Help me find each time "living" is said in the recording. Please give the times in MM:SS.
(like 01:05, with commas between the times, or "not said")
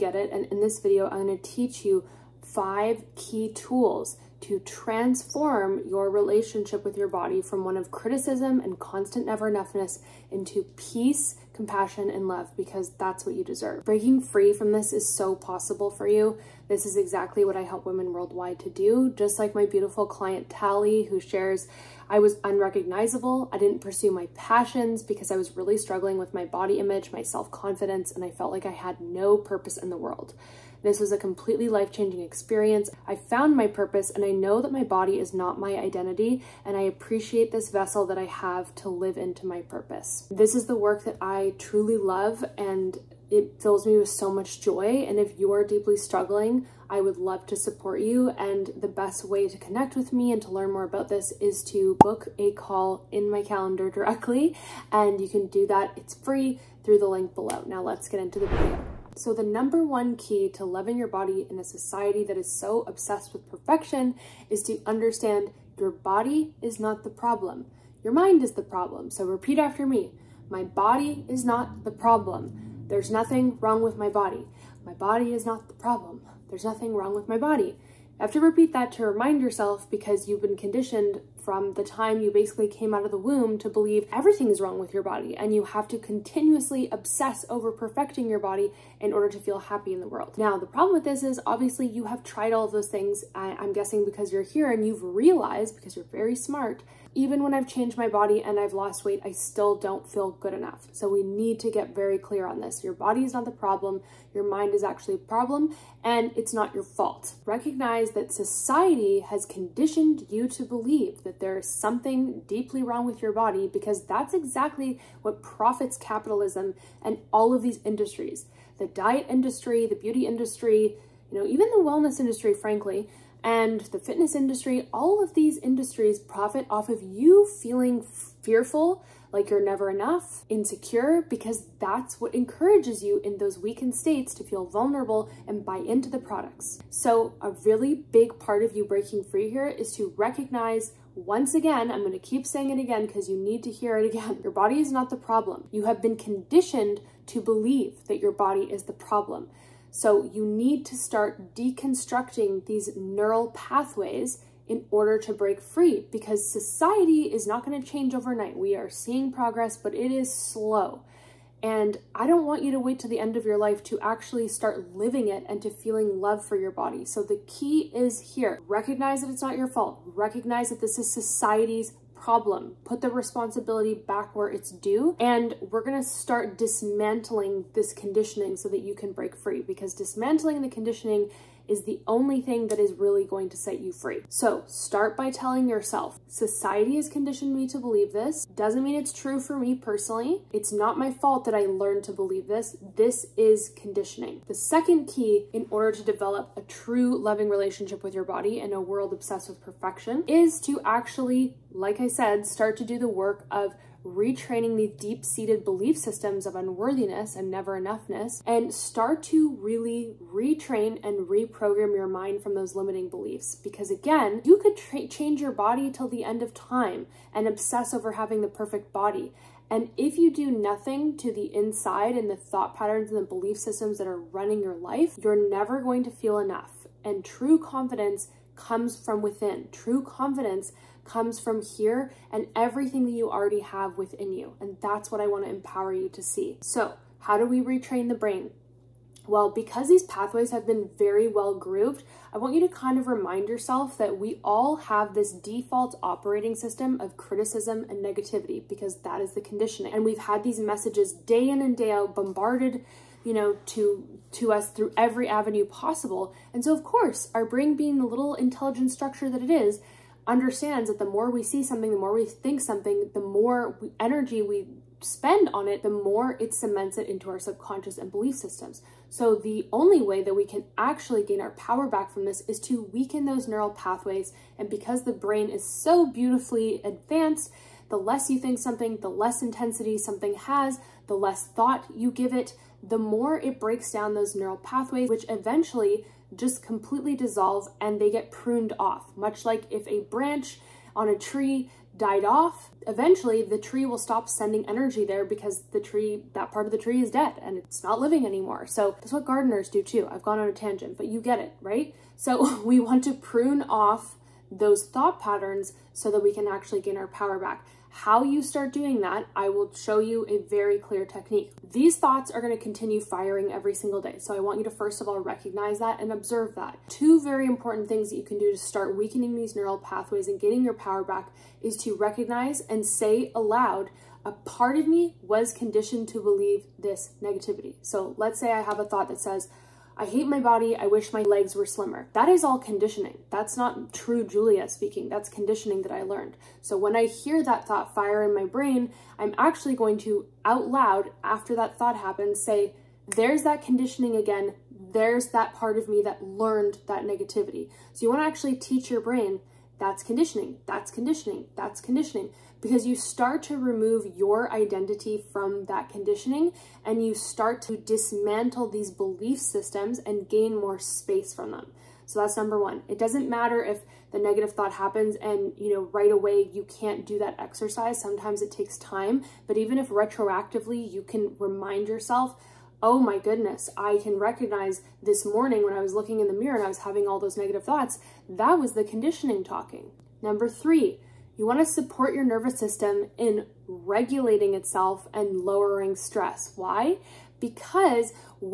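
02:44, 04:57.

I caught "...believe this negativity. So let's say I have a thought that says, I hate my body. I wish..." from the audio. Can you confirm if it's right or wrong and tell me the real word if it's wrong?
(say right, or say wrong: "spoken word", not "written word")
right.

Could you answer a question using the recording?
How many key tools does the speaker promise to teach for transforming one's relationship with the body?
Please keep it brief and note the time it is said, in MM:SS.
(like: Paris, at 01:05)
5, at 00:02.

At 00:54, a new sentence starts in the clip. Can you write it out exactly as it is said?
And you can do that, it's free through the link below.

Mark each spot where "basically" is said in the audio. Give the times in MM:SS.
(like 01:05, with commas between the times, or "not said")
01:22.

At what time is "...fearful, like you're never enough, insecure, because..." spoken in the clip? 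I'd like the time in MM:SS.
02:08.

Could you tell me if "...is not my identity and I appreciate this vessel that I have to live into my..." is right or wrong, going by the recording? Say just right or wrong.
right.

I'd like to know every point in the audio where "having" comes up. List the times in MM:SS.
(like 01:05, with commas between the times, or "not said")
03:38, 06:16.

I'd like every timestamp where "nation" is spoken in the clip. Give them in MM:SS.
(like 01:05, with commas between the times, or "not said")
not said.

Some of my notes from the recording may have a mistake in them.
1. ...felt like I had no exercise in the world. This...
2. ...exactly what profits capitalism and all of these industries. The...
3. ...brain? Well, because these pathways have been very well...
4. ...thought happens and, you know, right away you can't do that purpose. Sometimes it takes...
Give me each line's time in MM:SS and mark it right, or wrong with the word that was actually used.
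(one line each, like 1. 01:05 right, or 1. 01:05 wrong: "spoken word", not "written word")
1. 00:28 wrong: "purpose", not "exercise"
2. 01:54 right
3. 03:58 right
4. 06:04 wrong: "exercise", not "purpose".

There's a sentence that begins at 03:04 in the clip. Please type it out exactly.
So start by telling yourself, society has conditioned me to believe this.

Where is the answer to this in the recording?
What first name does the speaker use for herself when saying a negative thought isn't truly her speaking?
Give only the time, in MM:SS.
05:34.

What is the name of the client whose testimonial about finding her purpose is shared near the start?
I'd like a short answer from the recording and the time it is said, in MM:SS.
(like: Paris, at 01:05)
Tally, at 00:20.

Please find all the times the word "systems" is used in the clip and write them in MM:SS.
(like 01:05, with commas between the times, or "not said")
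03:25, 03:43, 04:06, 04:28, 05:59, 06:22.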